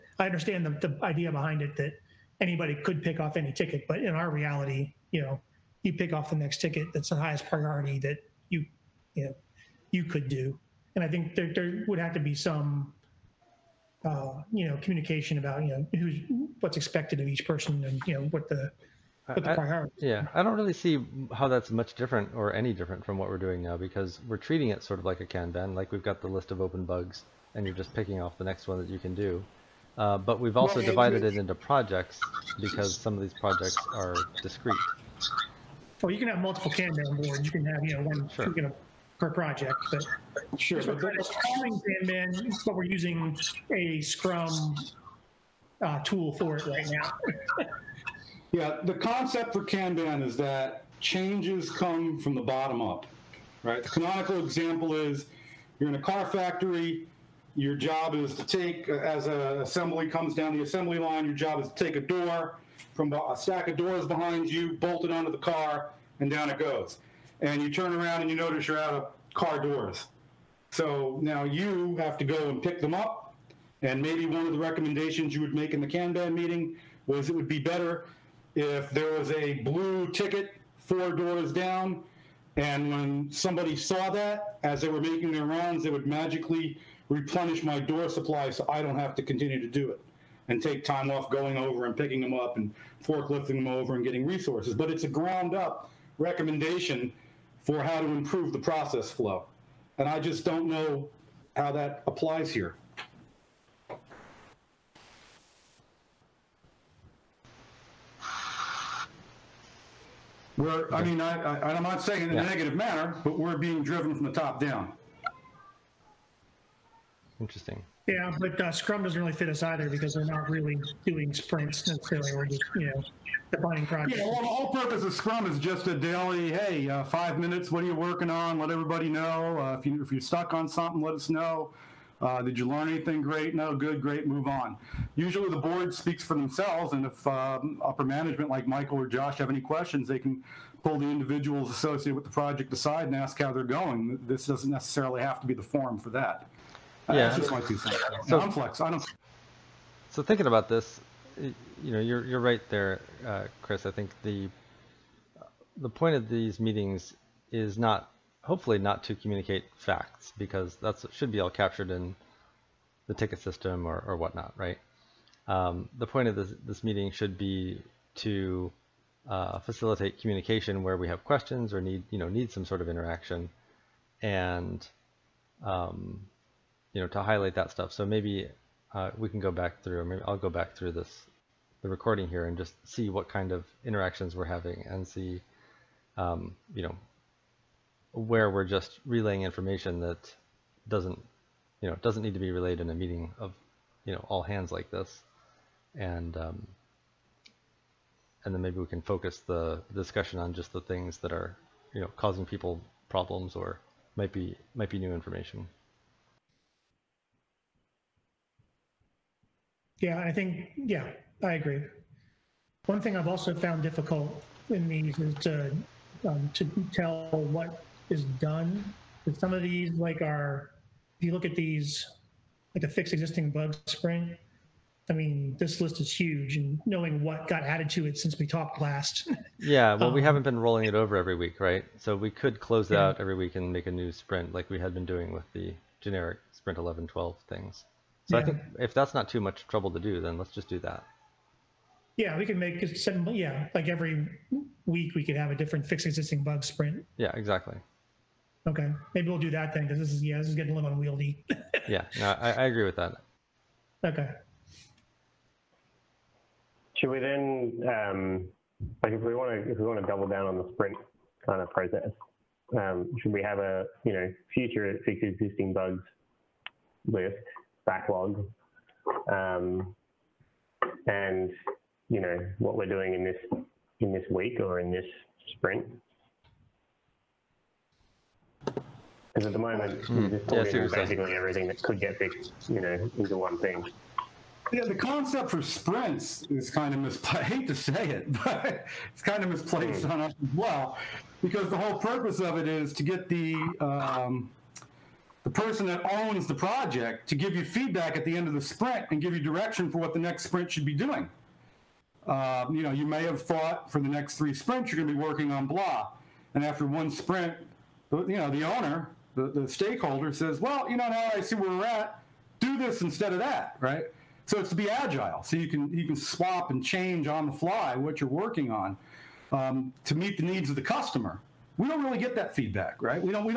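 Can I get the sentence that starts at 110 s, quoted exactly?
We're, I mean, I, I, I'm not saying in yeah.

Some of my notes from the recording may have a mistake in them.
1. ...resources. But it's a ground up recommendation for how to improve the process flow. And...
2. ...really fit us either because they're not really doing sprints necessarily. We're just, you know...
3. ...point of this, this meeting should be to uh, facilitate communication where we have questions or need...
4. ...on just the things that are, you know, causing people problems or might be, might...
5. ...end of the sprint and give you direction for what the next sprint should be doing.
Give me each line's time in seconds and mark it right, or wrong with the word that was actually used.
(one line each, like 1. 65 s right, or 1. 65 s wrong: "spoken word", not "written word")
1. 94 s right
2. 119 s right
3. 166 s right
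4. 200 s right
5. 298 s right.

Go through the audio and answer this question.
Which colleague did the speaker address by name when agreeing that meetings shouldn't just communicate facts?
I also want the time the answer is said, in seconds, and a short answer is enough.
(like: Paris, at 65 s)
Chris, at 153 s.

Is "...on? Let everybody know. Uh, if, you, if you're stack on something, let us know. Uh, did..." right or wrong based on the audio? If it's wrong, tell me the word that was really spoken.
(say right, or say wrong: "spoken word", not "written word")
wrong: "stuck", not "stack".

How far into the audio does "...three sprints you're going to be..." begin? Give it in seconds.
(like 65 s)
304 s.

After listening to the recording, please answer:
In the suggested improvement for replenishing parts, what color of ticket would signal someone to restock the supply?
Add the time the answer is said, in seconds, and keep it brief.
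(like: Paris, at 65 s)
blue, at 79 s.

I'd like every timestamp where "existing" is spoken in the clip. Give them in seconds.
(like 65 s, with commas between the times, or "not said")
223 s, 246 s, 265 s.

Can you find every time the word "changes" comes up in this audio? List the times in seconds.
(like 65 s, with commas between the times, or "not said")
50 s, 316 s.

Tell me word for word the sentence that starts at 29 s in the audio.
Uh, but we've also well, divided it, it into projects because some of these projects are discrete.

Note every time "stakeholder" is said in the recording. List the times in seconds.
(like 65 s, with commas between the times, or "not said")
309 s.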